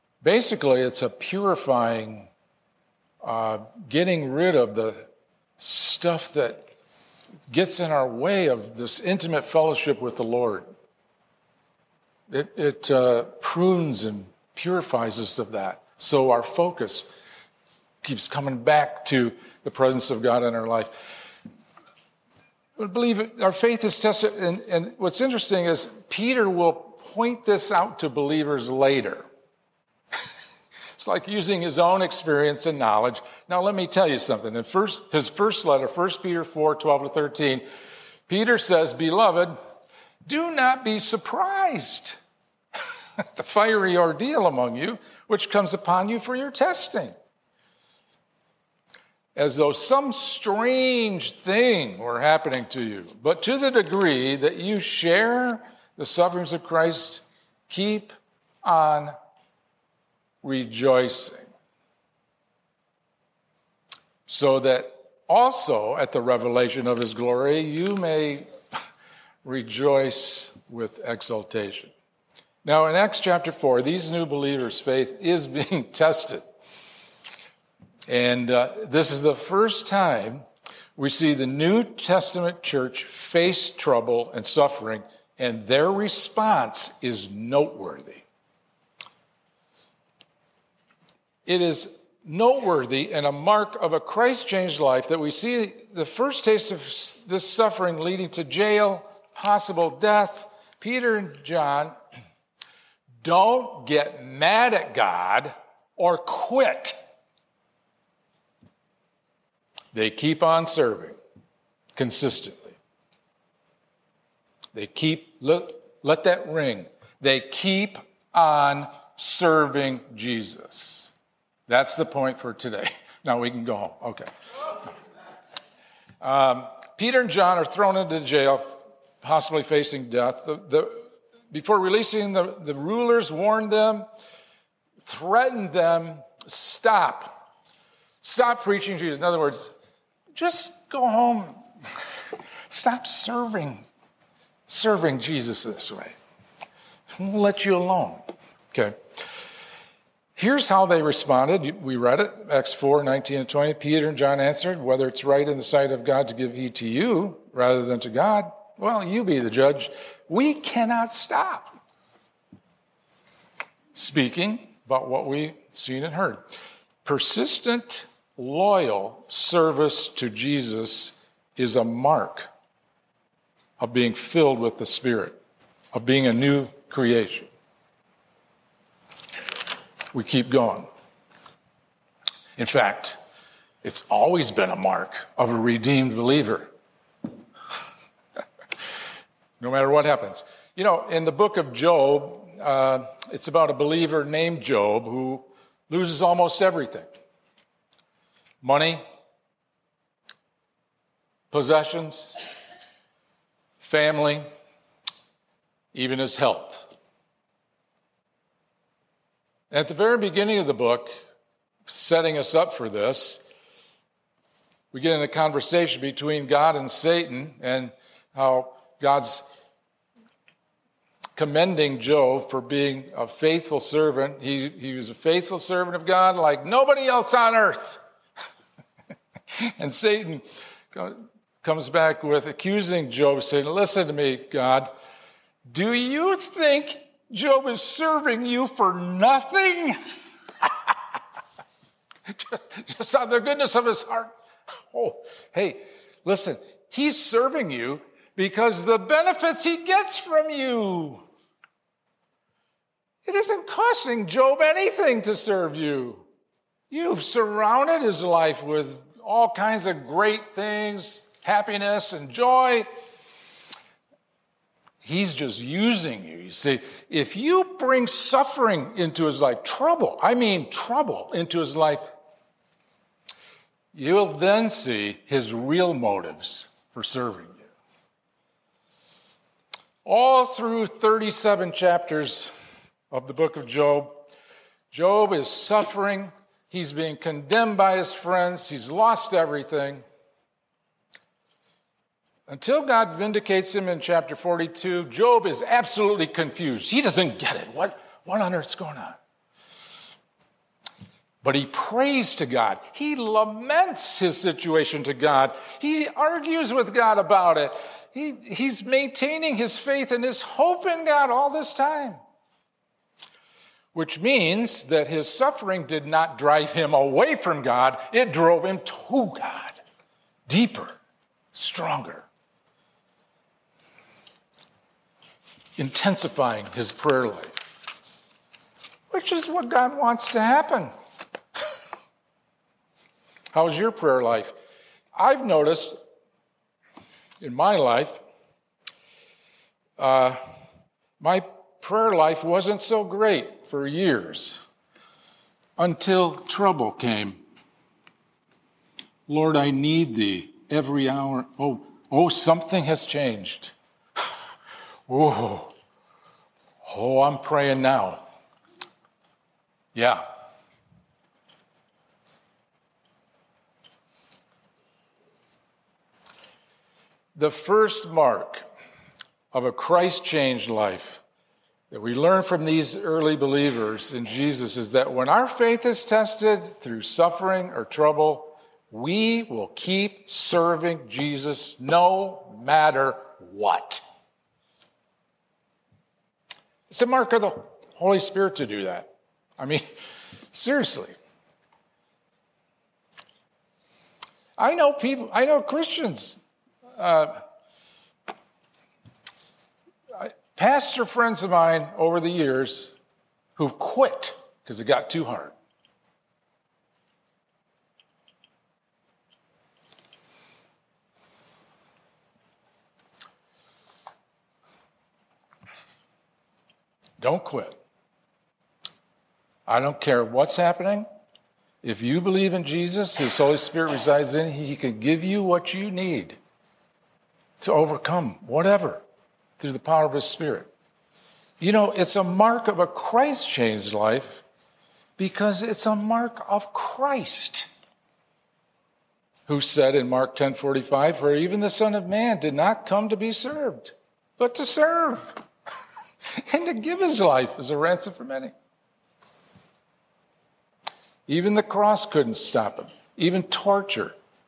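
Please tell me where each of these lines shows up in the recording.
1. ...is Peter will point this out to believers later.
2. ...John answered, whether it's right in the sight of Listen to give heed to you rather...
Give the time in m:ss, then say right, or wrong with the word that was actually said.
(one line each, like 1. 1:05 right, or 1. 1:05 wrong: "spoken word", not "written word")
1. 0:25 right
2. 2:34 wrong: "God", not "Listen".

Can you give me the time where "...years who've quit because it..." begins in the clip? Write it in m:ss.
6:42.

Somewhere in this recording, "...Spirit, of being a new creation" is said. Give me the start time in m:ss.
2:54.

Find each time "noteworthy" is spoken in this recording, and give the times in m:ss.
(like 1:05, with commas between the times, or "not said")
1:27, 1:32.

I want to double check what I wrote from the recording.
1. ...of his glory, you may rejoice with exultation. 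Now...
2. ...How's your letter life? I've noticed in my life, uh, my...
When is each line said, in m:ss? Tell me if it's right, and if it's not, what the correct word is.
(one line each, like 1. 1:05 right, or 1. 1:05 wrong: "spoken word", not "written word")
1. 1:06 right
2. 5:33 wrong: "prayer", not "letter".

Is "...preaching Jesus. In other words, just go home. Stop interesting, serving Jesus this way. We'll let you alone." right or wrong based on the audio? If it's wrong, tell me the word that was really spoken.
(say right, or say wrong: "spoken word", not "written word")
wrong: "serving", not "interesting".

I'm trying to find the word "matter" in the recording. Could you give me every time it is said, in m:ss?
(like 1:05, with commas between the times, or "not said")
3:09, 6:22.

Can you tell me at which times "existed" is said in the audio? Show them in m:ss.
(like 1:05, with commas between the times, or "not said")
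not said.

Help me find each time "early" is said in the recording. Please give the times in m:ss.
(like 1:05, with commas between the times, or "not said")
6:12.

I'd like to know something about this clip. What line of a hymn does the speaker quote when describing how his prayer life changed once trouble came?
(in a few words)
Lord, I need thee every hour.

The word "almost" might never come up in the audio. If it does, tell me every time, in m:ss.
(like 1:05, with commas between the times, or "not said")
3:16.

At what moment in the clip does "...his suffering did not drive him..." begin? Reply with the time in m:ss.
5:15.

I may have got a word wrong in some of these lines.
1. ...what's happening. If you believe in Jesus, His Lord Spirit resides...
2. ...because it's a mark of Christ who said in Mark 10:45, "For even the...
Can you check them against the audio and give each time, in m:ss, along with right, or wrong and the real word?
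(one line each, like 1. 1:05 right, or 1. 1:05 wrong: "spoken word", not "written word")
1. 7:00 wrong: "Holy", not "Lord"
2. 7:15 right.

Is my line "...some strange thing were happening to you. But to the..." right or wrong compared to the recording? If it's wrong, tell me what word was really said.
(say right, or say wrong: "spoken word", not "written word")
right.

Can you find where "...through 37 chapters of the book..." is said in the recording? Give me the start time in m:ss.
4:40.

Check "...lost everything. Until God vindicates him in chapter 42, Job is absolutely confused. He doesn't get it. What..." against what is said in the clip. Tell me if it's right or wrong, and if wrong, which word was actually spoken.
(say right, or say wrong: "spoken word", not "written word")
right.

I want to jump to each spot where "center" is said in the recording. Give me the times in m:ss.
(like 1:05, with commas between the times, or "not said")
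not said.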